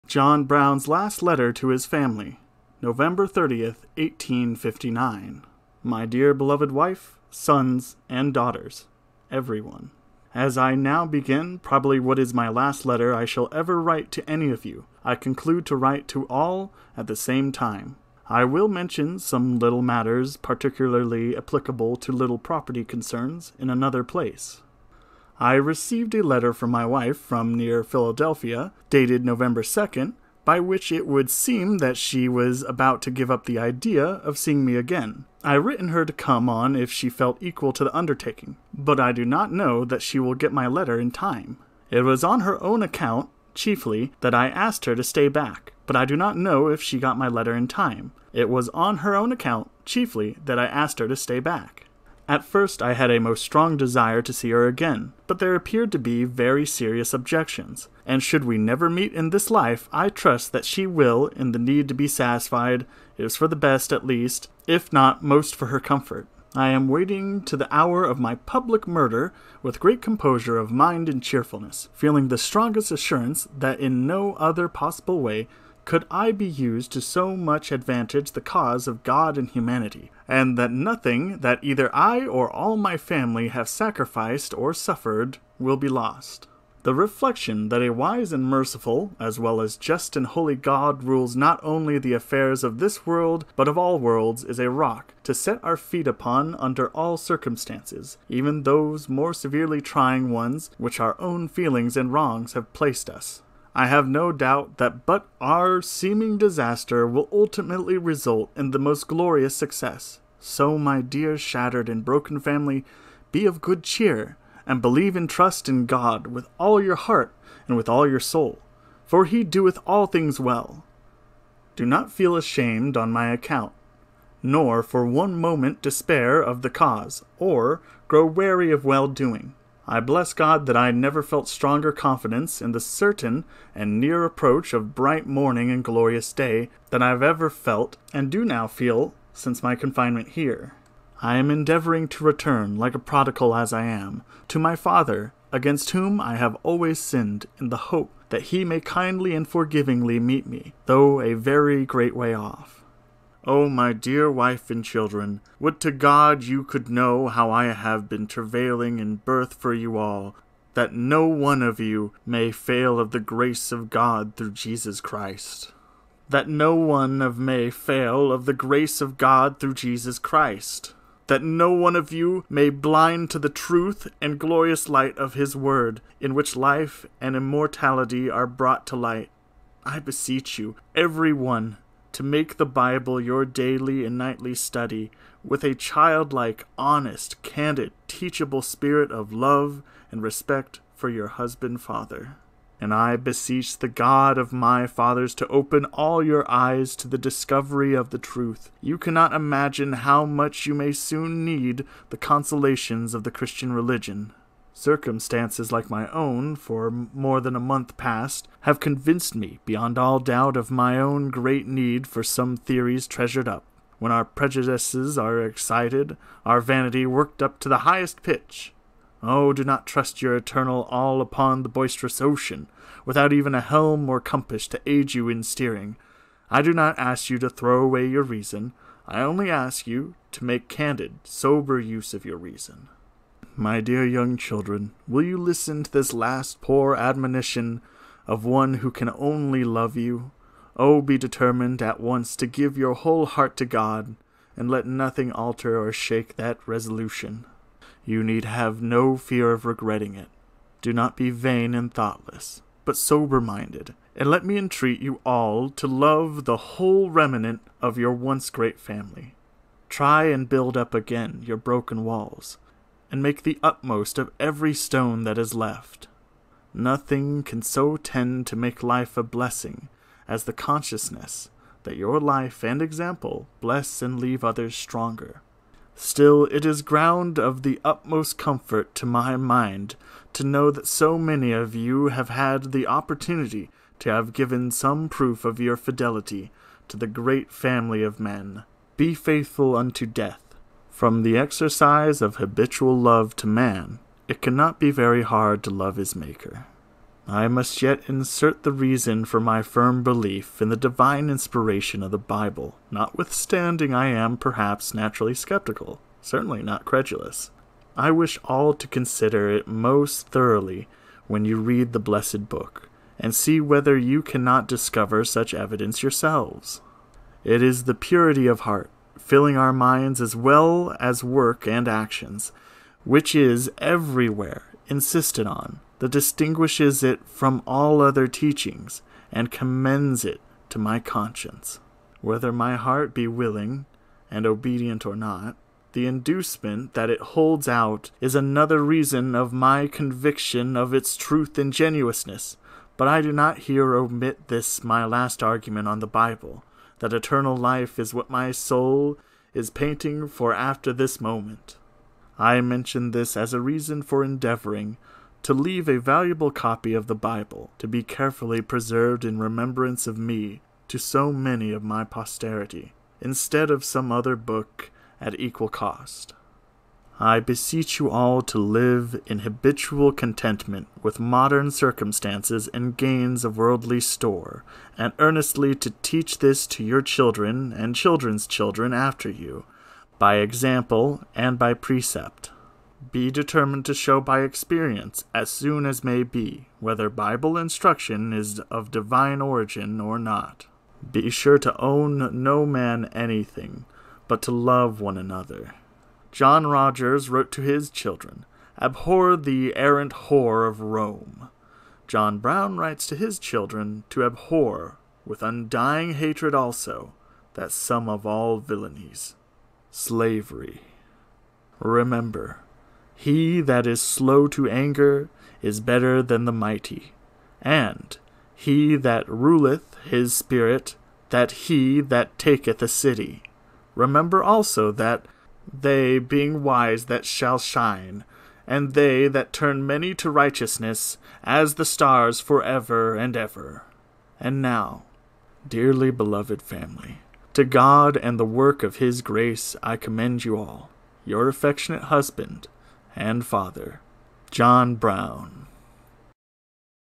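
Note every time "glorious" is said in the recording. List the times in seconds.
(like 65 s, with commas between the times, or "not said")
109 s, 135 s, 174 s.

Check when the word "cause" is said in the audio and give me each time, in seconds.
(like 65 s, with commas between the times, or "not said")
78 s, 126 s.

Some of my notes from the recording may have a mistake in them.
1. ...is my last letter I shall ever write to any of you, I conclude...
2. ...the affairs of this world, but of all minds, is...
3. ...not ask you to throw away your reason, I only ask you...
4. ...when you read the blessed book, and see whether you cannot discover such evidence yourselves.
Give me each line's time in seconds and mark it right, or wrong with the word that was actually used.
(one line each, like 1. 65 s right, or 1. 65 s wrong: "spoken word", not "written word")
1. 12 s right
2. 91 s wrong: "worlds", not "minds"
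3. 226 s right
4. 311 s right.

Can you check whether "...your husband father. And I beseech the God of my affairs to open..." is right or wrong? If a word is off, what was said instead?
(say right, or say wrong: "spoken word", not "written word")
wrong: "fathers", not "affairs".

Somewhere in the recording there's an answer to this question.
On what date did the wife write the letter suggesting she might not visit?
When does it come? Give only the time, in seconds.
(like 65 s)
29 s.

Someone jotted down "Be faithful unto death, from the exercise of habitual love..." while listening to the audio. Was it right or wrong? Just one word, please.
right.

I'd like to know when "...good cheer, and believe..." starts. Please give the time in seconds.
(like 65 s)
113 s.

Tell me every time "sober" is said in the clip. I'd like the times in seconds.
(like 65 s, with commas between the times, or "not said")
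231 s, 252 s.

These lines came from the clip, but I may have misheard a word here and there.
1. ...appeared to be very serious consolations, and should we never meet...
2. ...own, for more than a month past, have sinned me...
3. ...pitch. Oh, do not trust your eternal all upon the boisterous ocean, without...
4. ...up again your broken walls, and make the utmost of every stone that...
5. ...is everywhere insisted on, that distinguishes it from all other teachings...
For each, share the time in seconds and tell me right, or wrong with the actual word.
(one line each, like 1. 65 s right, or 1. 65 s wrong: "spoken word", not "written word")
1. 55 s wrong: "objections", not "consolations"
2. 206 s wrong: "convinced", not "sinned"
3. 218 s right
4. 260 s right
5. 323 s right.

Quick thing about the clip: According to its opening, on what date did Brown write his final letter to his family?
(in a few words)
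November 30th, 1859.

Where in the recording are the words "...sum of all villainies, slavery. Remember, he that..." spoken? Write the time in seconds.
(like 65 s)
407 s.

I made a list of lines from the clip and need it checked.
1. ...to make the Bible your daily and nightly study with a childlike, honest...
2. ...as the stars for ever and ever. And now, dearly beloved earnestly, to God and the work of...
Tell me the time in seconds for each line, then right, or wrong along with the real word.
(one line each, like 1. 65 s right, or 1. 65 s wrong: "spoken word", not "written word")
1. 182 s right
2. 431 s wrong: "family", not "earnestly".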